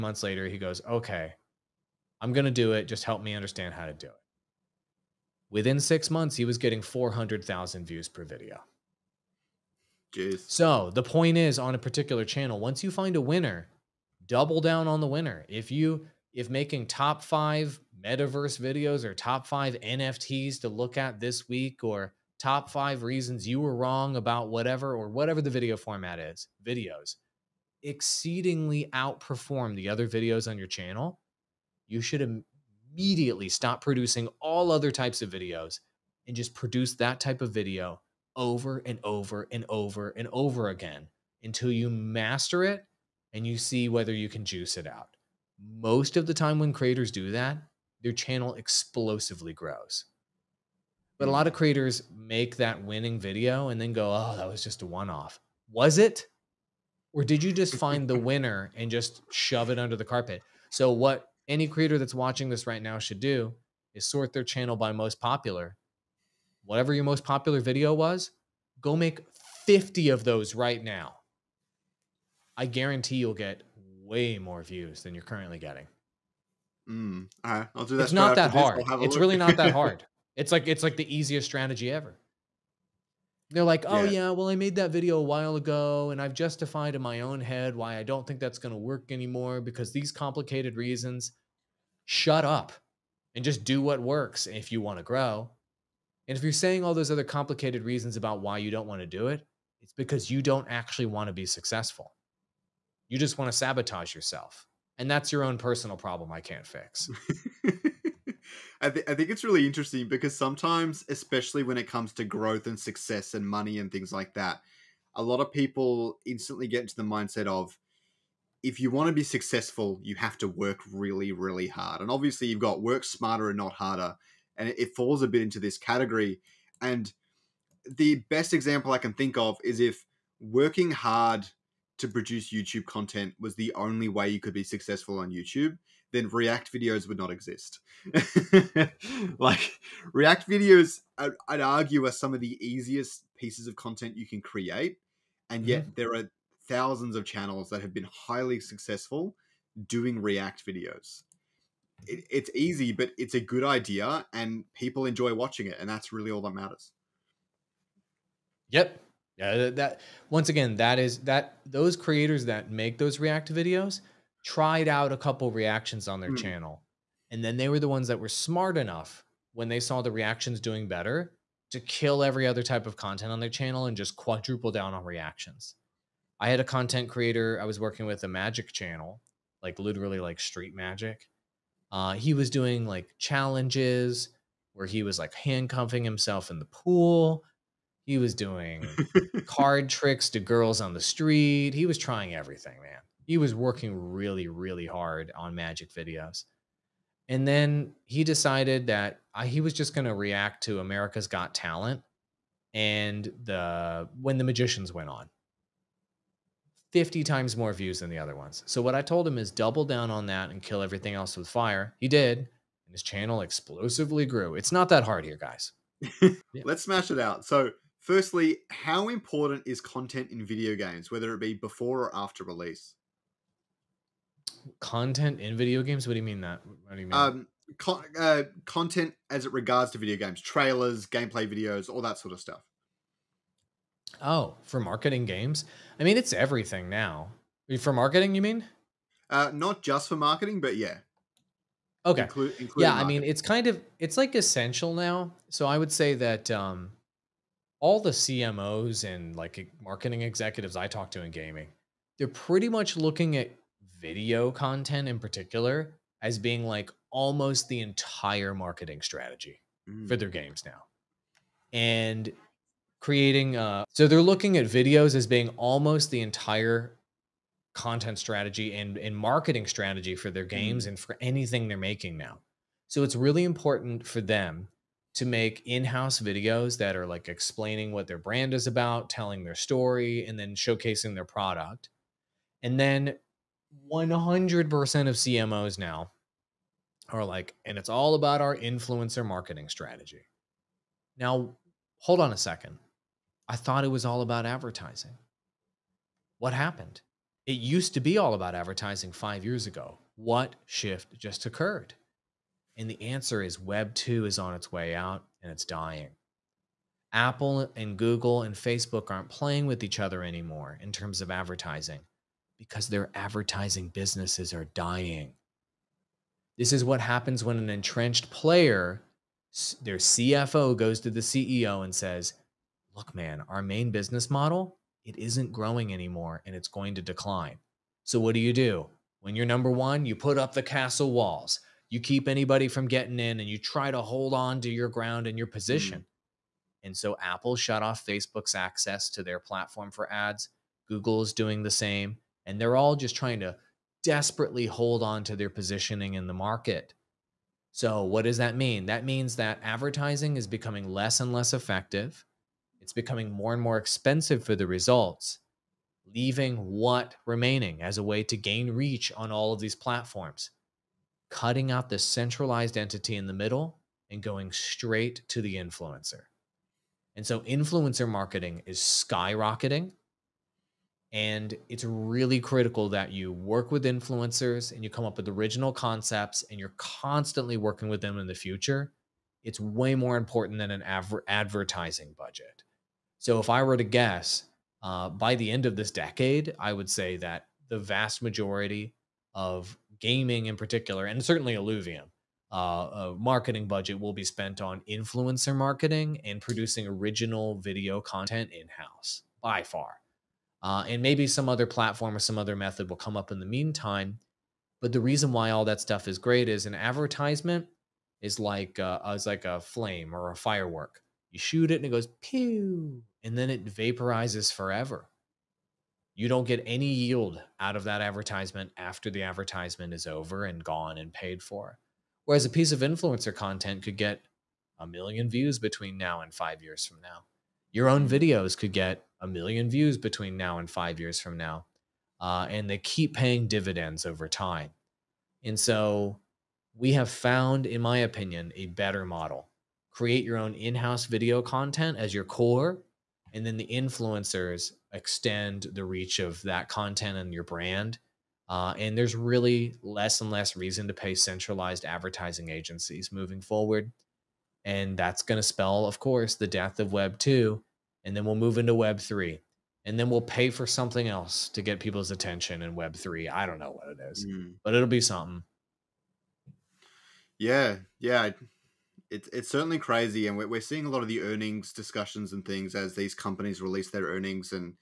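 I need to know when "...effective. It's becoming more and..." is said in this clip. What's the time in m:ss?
5:51.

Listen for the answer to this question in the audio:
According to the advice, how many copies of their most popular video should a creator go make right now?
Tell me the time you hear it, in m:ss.
1:08.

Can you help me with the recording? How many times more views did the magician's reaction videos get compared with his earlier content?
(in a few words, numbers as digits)
50.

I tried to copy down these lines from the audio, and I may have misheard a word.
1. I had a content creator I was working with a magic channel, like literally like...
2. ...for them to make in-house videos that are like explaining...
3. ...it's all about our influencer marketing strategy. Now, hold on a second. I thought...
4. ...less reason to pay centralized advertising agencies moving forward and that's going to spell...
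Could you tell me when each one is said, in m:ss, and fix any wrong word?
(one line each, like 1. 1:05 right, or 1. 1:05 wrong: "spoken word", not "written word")
1. 2:56 right
2. 4:34 right
3. 4:47 right
4. 7:30 right.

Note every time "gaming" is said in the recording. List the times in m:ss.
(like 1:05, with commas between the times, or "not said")
4:11, 6:29.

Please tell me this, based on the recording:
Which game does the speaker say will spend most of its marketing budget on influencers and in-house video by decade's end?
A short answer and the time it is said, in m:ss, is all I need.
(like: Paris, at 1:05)
Illuvium, at 6:31.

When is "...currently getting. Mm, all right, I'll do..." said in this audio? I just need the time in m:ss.
1:15.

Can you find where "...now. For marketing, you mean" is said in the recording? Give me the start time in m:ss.
3:56.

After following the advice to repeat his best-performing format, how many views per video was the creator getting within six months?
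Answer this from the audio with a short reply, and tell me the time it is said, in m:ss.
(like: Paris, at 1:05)
400,000, at 0:06.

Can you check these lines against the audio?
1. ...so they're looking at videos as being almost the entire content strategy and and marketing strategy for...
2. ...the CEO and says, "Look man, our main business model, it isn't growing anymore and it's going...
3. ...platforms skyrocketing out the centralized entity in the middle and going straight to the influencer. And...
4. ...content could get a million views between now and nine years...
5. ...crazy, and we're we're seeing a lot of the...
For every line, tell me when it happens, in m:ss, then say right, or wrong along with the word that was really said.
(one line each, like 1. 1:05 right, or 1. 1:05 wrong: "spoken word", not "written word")
1. 4:23 right
2. 5:21 right
3. 5:59 wrong: "cutting", not "skyrocketing"
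4. 7:03 wrong: "five", not "nine"
5. 7:49 right.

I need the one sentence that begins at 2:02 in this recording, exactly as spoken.
And obviously, you've got work smarter and not harder.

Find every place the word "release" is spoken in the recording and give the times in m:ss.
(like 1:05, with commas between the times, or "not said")
3:42, 7:53.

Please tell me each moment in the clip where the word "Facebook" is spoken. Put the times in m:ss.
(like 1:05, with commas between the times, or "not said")
5:08, 5:38.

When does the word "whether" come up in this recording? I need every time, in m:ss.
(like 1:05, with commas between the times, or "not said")
0:43, 3:41.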